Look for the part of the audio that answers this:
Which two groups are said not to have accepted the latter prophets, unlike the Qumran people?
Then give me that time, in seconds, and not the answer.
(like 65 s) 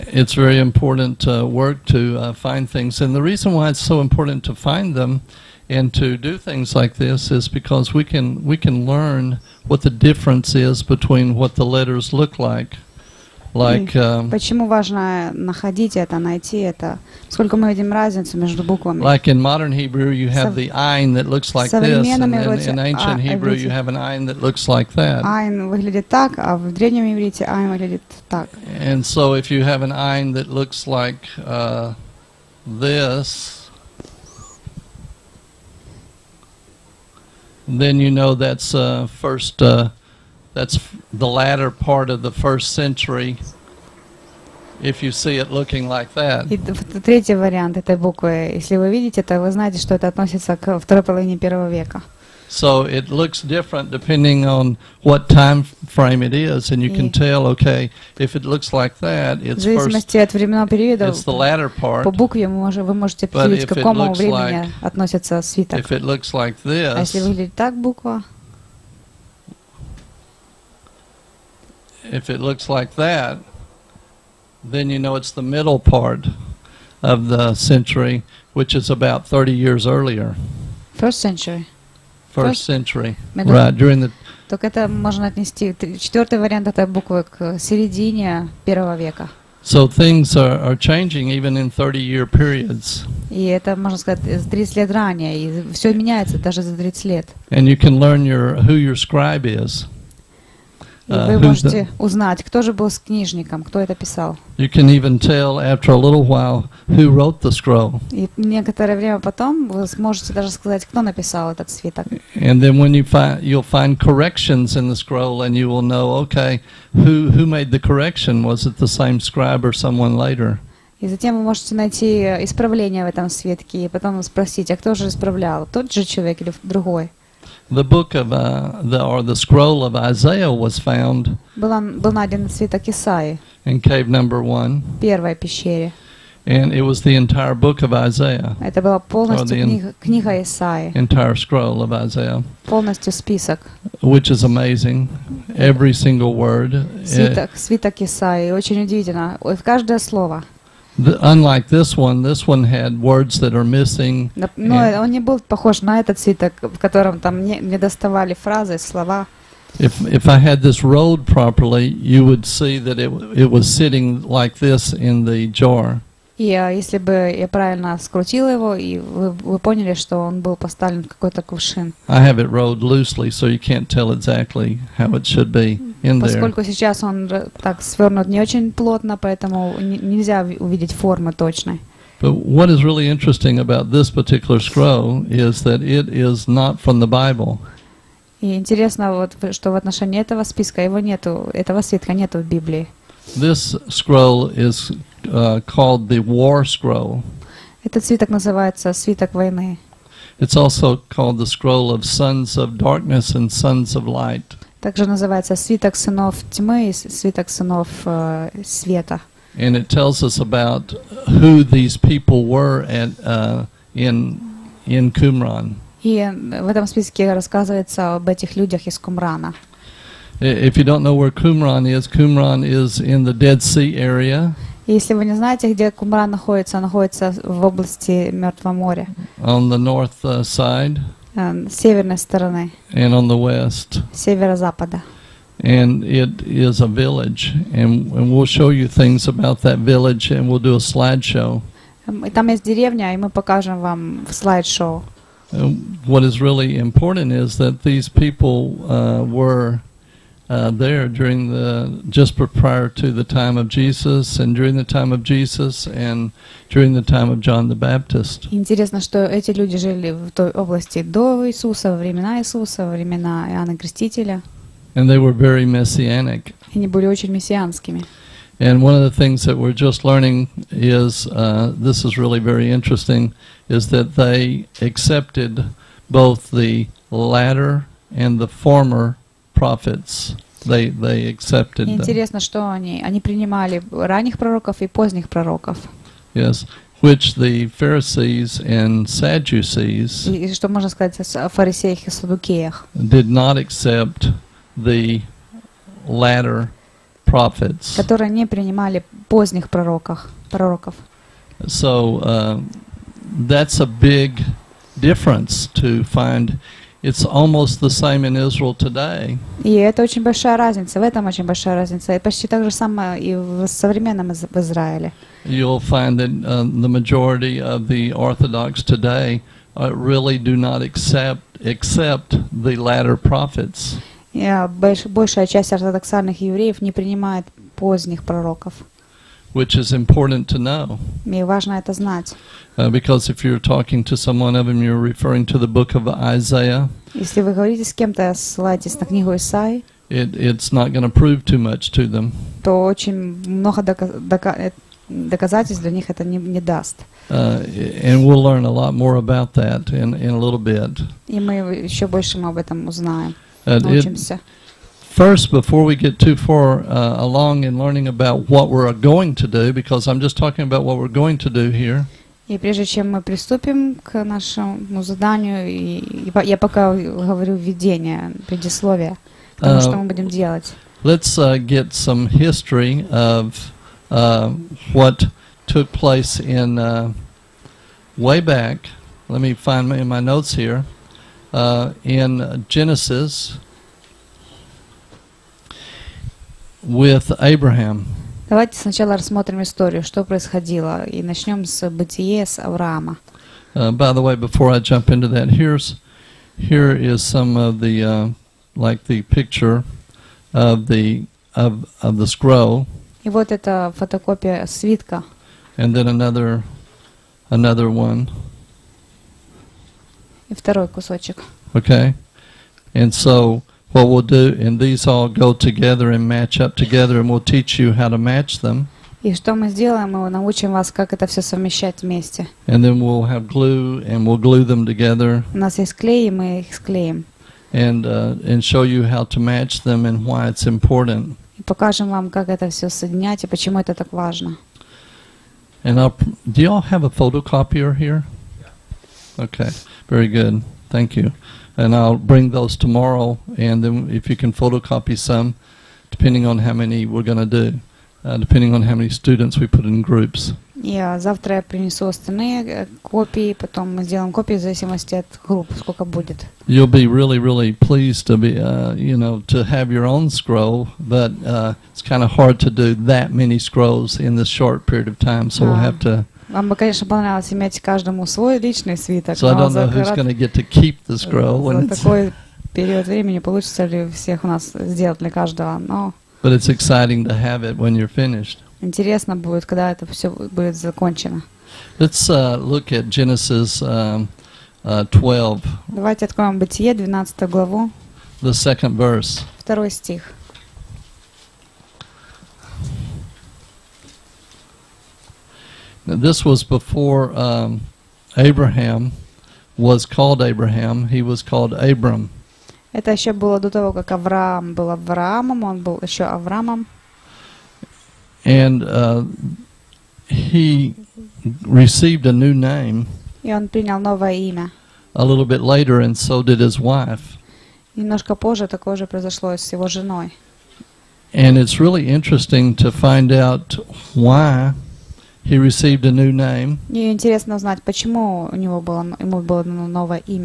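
287 s.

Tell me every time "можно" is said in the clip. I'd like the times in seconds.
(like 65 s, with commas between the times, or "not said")
84 s, 93 s, 290 s.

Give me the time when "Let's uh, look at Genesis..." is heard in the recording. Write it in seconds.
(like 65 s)
481 s.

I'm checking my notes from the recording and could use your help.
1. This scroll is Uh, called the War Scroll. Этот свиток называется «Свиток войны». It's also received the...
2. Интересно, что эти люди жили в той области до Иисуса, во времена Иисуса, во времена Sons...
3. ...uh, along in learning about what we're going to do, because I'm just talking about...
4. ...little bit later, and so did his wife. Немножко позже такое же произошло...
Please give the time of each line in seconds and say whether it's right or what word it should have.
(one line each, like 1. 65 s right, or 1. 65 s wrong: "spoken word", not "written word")
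1. 193 s wrong: "called", not "received"
2. 258 s wrong: "Иоанна", not "Sons"
3. 356 s right
4. 515 s right.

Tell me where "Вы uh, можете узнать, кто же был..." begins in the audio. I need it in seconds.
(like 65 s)
101 s.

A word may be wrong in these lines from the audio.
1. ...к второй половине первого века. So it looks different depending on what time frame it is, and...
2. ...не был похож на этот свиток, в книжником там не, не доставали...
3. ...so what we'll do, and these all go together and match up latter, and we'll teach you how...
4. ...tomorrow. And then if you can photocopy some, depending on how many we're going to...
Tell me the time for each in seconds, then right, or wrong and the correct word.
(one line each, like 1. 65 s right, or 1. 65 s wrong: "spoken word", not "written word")
1. 50 s right
2. 155 s wrong: "котором", not "книжником"
3. 413 s wrong: "together", not "latter"
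4. 442 s right.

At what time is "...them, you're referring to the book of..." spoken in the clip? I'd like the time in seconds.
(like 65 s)
334 s.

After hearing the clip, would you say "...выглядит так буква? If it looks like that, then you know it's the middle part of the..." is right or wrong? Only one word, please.
right.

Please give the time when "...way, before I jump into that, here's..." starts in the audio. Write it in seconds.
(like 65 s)
394 s.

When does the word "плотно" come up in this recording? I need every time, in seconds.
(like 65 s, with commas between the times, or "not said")
178 s.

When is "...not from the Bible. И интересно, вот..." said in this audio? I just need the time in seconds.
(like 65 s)
186 s.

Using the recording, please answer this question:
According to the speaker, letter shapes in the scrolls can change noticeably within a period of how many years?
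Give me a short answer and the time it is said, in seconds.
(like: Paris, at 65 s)
30, at 91 s.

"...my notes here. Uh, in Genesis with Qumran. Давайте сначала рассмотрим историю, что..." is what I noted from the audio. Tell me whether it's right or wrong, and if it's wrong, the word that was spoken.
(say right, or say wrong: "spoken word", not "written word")
wrong: "Abraham", not "Qumran".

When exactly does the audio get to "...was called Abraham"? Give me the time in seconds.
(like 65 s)
499 s.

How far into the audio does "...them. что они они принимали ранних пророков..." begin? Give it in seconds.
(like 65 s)
282 s.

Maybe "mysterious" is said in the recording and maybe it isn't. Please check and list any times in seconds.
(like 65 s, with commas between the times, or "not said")
not said.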